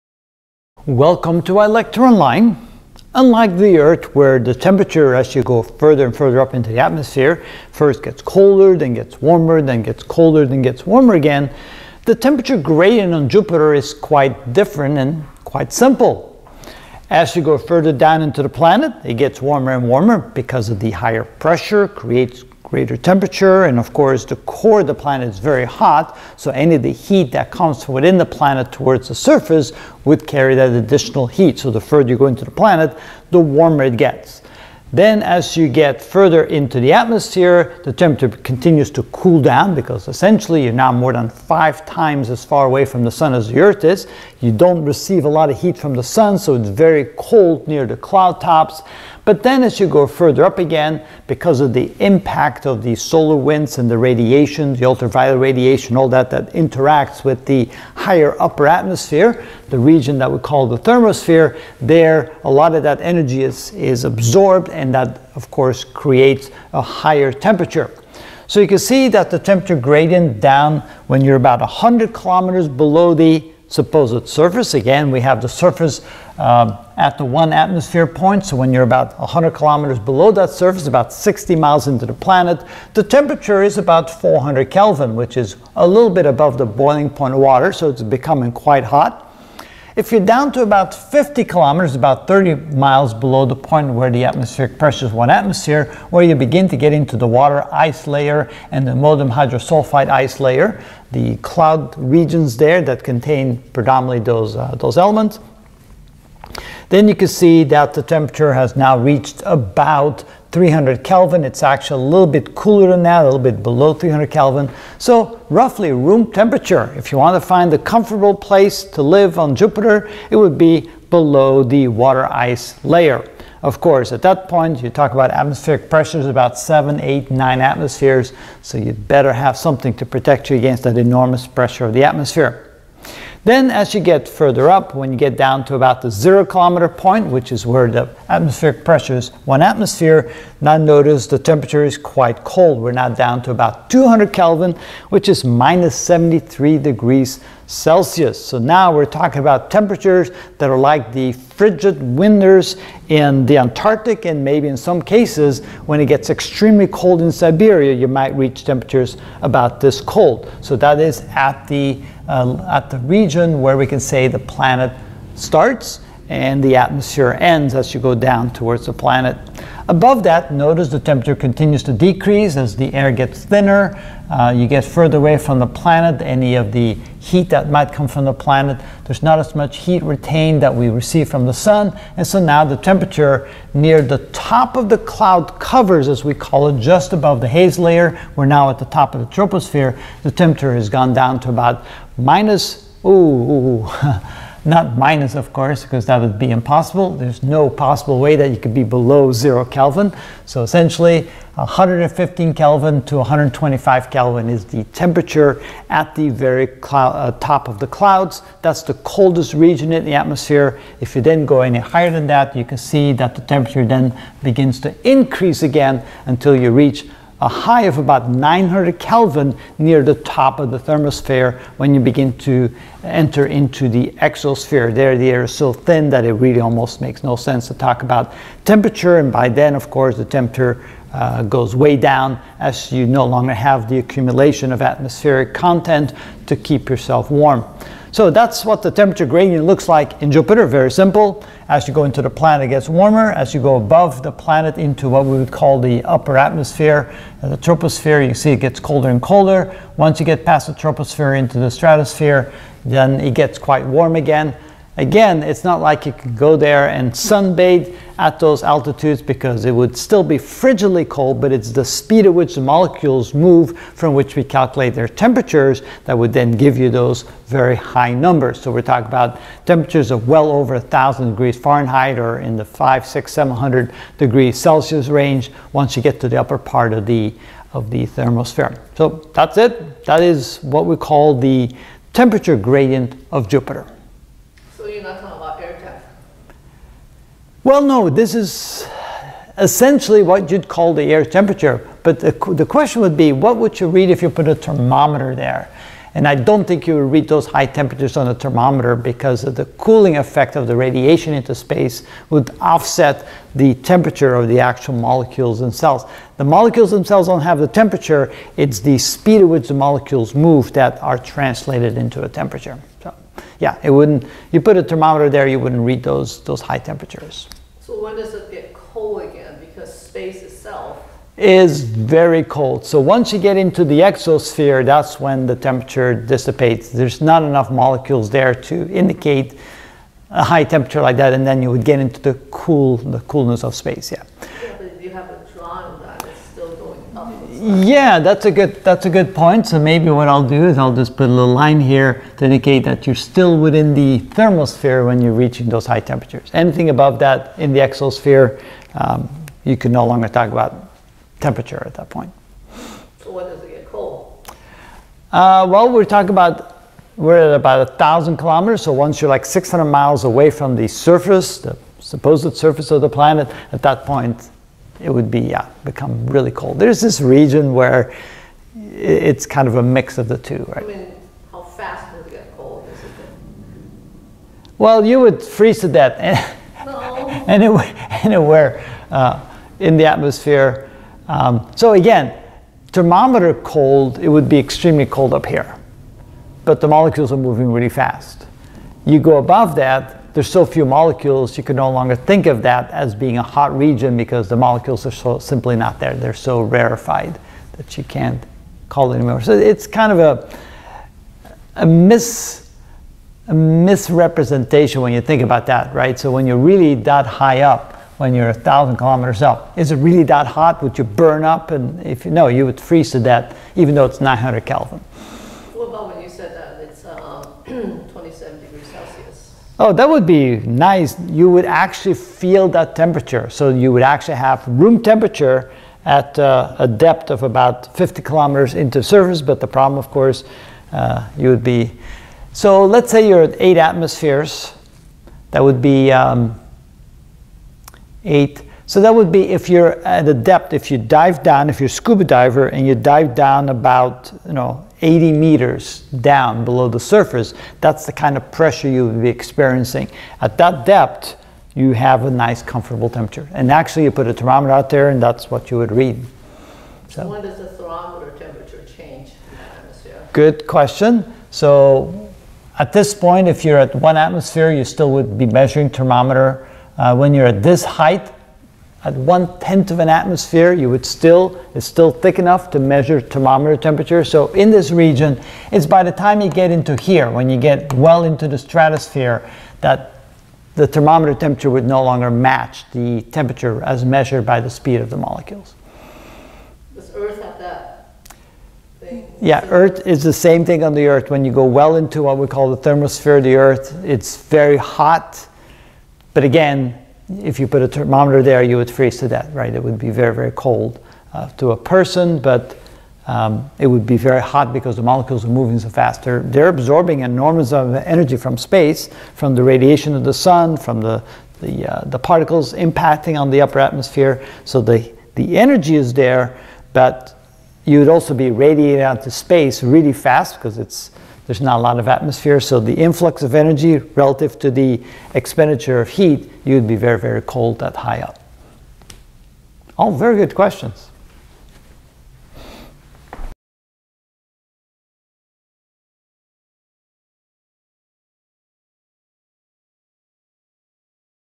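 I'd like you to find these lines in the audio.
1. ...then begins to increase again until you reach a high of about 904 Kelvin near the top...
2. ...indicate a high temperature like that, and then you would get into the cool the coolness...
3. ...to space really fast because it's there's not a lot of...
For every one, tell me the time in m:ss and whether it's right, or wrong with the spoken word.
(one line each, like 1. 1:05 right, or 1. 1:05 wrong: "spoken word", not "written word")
1. 3:33 wrong: "900", not "904"
2. 5:28 right
3. 8:39 right.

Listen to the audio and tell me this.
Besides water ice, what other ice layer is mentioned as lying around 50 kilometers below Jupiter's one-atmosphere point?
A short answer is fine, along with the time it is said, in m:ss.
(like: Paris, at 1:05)
molybdenum hydrosulfide ice, at 1:38.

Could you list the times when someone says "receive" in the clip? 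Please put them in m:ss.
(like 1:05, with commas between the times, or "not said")
0:44, 3:00.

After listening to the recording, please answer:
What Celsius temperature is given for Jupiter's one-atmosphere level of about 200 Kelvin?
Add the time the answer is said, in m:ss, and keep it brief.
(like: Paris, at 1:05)
-73 degrees Celsius, at 2:25.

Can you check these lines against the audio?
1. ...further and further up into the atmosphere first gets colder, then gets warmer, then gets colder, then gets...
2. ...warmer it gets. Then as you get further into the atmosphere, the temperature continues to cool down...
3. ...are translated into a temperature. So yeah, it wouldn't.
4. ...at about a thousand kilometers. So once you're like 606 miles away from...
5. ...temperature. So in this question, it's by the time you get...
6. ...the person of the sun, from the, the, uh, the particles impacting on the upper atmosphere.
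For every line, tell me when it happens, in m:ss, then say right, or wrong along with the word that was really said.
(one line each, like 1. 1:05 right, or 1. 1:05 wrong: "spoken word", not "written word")
1. 0:05 right
2. 0:33 right
3. 5:11 right
4. 5:57 wrong: "600", not "606"
5. 7:53 wrong: "region", not "question"
6. 8:29 wrong: "radiation", not "person".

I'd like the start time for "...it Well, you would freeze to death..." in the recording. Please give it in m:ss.
6:13.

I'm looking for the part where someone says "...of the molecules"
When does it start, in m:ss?
8:05.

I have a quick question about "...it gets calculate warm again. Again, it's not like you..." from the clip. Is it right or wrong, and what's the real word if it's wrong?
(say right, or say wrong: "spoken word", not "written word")
wrong: "quite", not "calculate".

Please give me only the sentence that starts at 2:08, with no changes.
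So you'd better have something to protect you against that enormous pressure of the atmosphere.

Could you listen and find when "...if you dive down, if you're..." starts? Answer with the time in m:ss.
7:20.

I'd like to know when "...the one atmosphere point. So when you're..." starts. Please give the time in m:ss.
1:17.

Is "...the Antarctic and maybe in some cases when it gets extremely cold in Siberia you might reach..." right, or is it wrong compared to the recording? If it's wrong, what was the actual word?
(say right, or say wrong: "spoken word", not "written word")
right.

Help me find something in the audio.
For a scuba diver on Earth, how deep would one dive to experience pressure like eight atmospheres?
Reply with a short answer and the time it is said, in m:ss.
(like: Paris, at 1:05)
80 meters, at 7:25.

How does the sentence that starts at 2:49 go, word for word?
Above that, notice the temperature continues to decrease as the air gets thinner.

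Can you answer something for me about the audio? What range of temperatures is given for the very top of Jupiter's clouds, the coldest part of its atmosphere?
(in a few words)
115 to 125 Kelvin.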